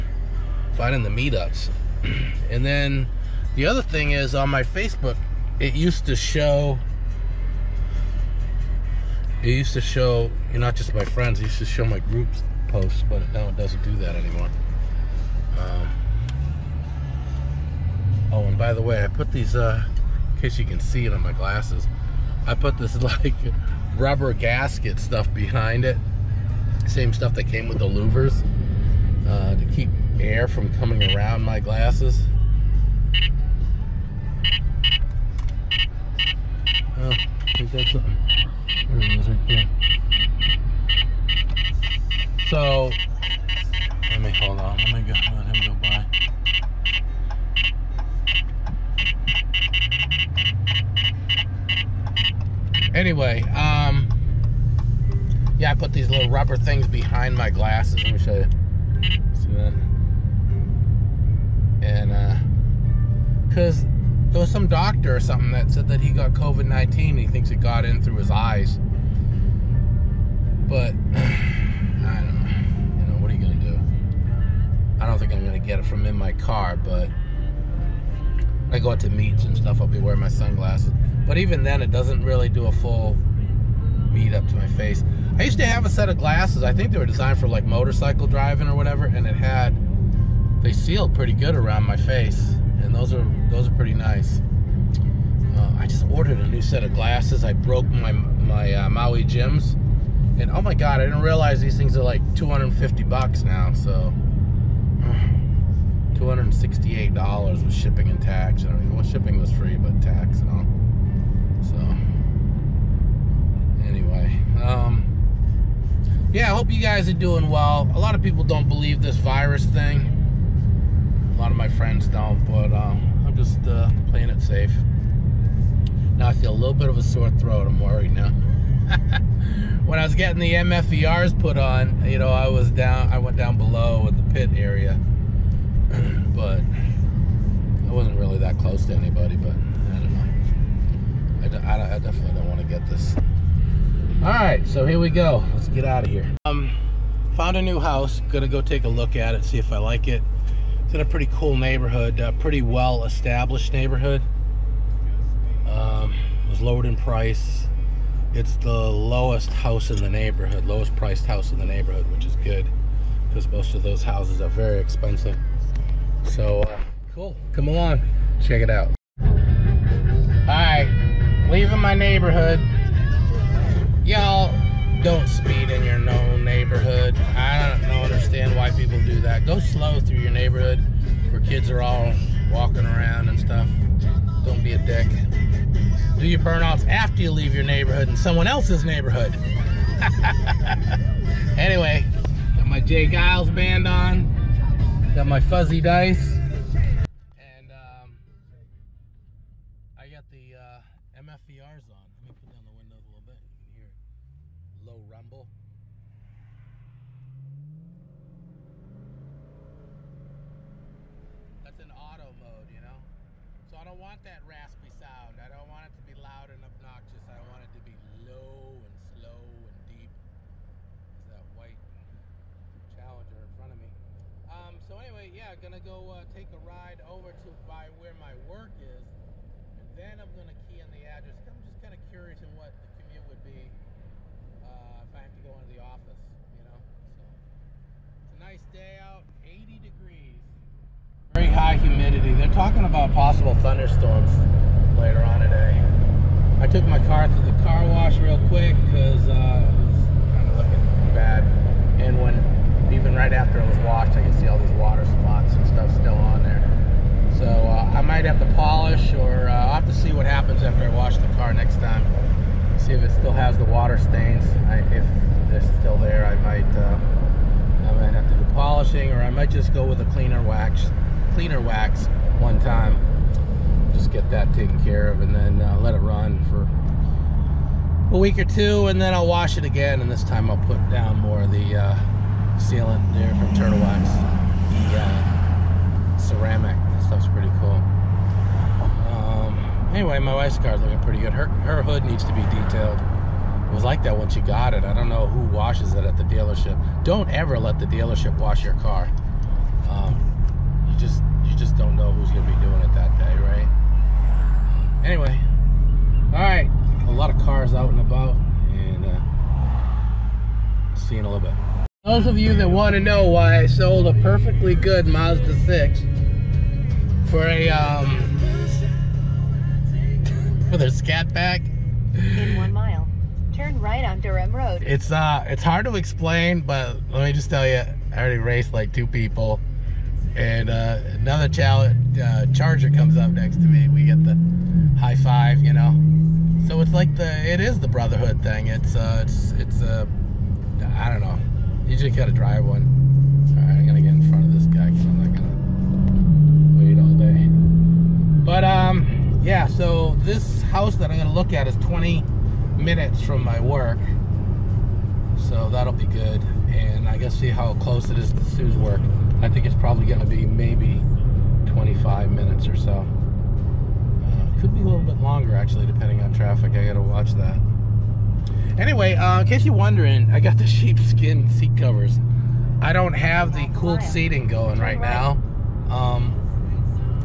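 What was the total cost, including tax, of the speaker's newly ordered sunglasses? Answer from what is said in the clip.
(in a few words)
$268.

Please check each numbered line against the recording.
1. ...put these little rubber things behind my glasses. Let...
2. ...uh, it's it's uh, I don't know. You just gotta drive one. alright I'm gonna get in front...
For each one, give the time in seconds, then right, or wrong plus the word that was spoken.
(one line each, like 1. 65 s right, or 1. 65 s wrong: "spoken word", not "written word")
1. 55 s right
2. 338 s right.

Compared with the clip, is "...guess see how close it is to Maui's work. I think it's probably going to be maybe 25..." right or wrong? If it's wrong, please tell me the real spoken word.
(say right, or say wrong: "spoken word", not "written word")
wrong: "Sue", not "Maui".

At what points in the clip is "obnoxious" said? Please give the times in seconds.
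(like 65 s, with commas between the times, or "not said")
216 s.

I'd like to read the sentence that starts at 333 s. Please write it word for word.
We get the high five, you know.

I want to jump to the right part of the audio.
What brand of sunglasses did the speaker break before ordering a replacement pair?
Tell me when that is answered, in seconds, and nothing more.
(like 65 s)
98 s.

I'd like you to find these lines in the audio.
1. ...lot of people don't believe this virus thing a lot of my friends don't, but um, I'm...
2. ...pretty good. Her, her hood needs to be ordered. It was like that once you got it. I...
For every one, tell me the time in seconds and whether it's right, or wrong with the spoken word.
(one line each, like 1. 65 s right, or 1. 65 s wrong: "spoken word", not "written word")
1. 117 s right
2. 290 s wrong: "detailed", not "ordered".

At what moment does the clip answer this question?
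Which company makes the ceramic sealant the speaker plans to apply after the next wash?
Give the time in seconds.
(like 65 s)
283 s.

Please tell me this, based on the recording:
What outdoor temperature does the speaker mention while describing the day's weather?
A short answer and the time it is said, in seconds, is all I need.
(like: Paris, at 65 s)
80 degrees, at 239 s.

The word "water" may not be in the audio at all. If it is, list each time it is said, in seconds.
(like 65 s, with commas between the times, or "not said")
254 s, 263 s.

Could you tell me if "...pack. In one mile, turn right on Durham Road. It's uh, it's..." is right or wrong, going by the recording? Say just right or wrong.
right.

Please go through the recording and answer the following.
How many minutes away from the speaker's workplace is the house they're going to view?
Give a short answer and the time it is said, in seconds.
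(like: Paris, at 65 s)
20, at 351 s.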